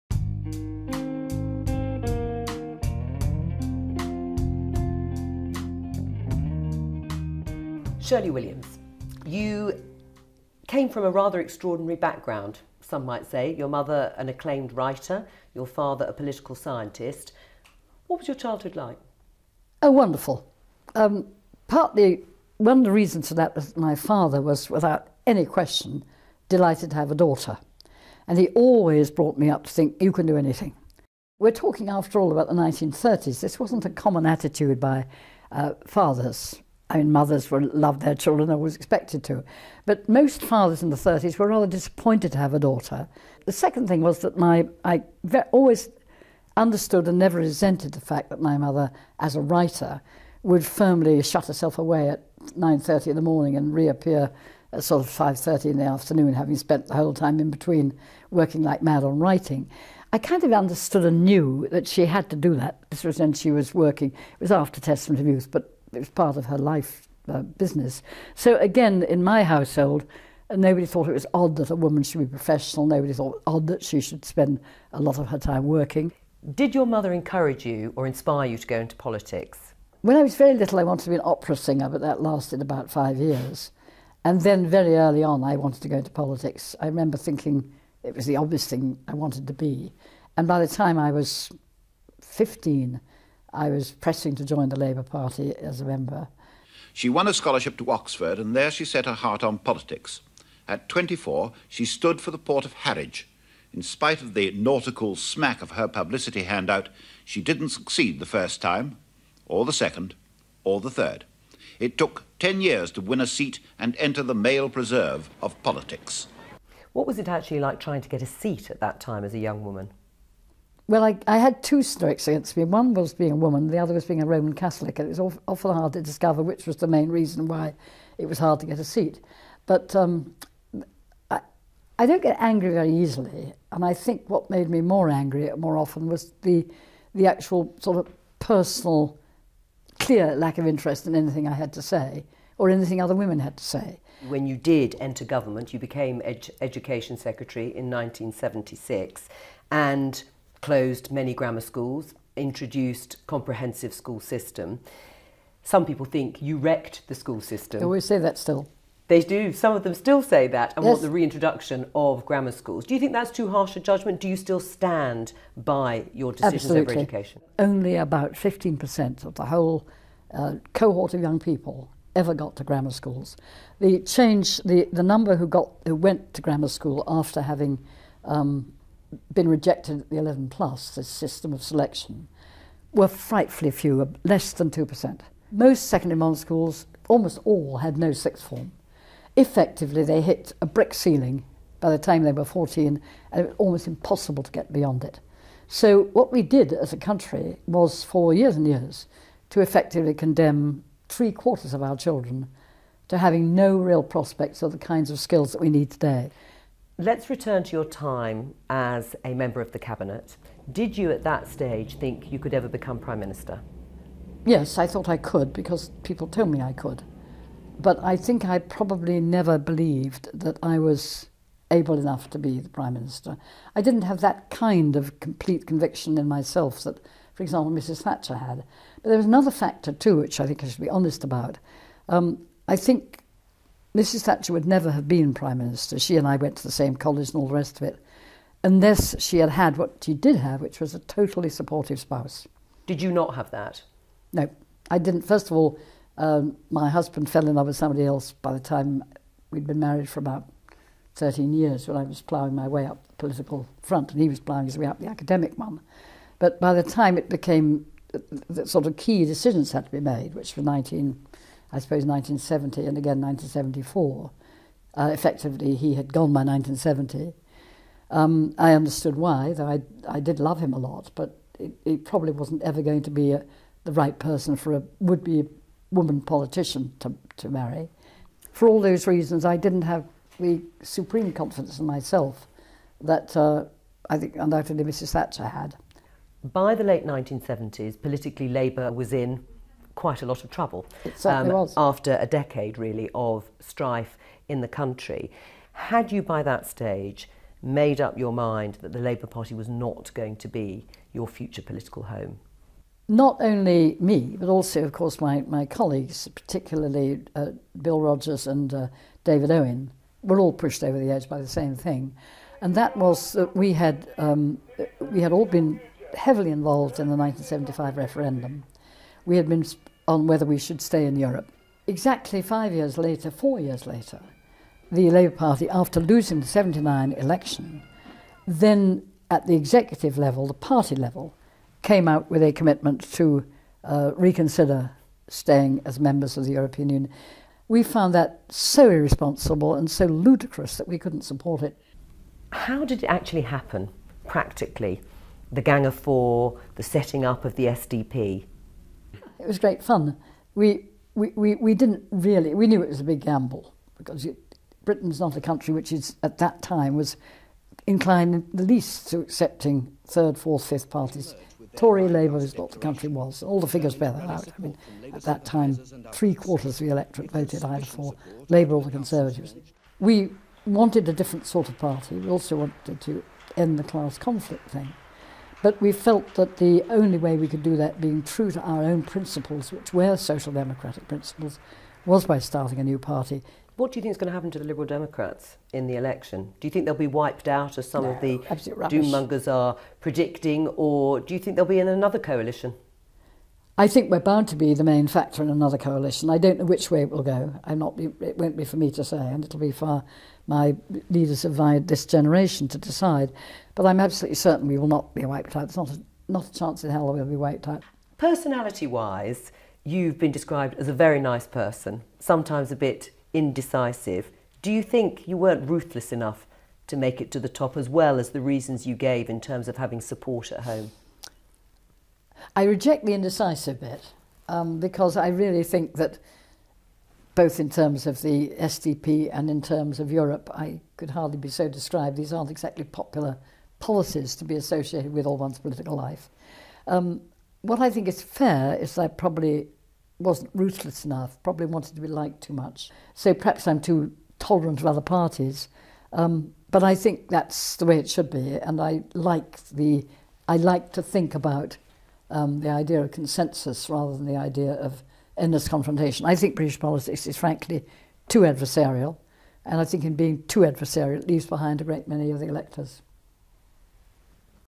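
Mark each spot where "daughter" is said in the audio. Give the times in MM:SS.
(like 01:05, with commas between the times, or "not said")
00:27, 00:42.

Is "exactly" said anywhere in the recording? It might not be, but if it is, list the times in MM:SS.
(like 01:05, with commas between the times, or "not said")
05:21, 07:12.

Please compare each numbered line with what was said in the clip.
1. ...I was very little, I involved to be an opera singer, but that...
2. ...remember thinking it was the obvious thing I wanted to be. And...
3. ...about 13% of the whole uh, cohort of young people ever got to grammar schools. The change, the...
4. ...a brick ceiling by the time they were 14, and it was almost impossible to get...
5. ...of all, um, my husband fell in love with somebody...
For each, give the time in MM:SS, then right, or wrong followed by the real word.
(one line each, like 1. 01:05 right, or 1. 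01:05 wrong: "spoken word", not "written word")
1. 01:20 wrong: "wanted", not "involved"
2. 01:26 right
3. 02:47 wrong: "15", not "13"
4. 03:10 right
5. 04:05 right.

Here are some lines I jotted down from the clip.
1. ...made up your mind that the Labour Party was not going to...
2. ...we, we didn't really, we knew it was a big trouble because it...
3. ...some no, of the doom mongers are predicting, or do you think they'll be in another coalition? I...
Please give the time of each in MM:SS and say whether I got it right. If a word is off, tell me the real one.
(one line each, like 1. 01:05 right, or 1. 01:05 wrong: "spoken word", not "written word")
1. 04:57 right
2. 05:51 wrong: "gamble", not "trouble"
3. 06:27 right.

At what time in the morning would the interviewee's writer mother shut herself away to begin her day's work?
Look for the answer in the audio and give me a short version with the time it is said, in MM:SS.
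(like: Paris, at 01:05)
9.30, at 00:52.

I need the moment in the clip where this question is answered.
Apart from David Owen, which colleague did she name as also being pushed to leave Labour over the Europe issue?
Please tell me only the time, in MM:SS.
05:07.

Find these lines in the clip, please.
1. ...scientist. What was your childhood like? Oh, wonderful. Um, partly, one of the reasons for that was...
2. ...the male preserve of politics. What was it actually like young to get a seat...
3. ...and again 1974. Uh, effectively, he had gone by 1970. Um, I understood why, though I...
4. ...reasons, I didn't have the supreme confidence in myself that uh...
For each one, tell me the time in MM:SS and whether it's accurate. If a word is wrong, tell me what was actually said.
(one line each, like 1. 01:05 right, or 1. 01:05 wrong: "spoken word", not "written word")
1. 00:16 right
2. 01:54 wrong: "trying", not "young"
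3. 04:22 right
4. 04:39 right.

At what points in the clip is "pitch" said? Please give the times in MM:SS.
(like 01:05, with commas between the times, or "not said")
not said.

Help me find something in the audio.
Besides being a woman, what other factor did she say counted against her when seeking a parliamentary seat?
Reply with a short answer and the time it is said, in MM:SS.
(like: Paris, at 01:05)
Roman Catholic, at 02:04.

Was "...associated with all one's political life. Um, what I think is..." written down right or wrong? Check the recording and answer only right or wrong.
right.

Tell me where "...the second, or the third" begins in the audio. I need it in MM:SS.
01:49.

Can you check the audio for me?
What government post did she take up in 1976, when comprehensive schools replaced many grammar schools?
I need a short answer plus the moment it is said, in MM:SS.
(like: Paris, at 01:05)
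Education Secretary, at 02:26.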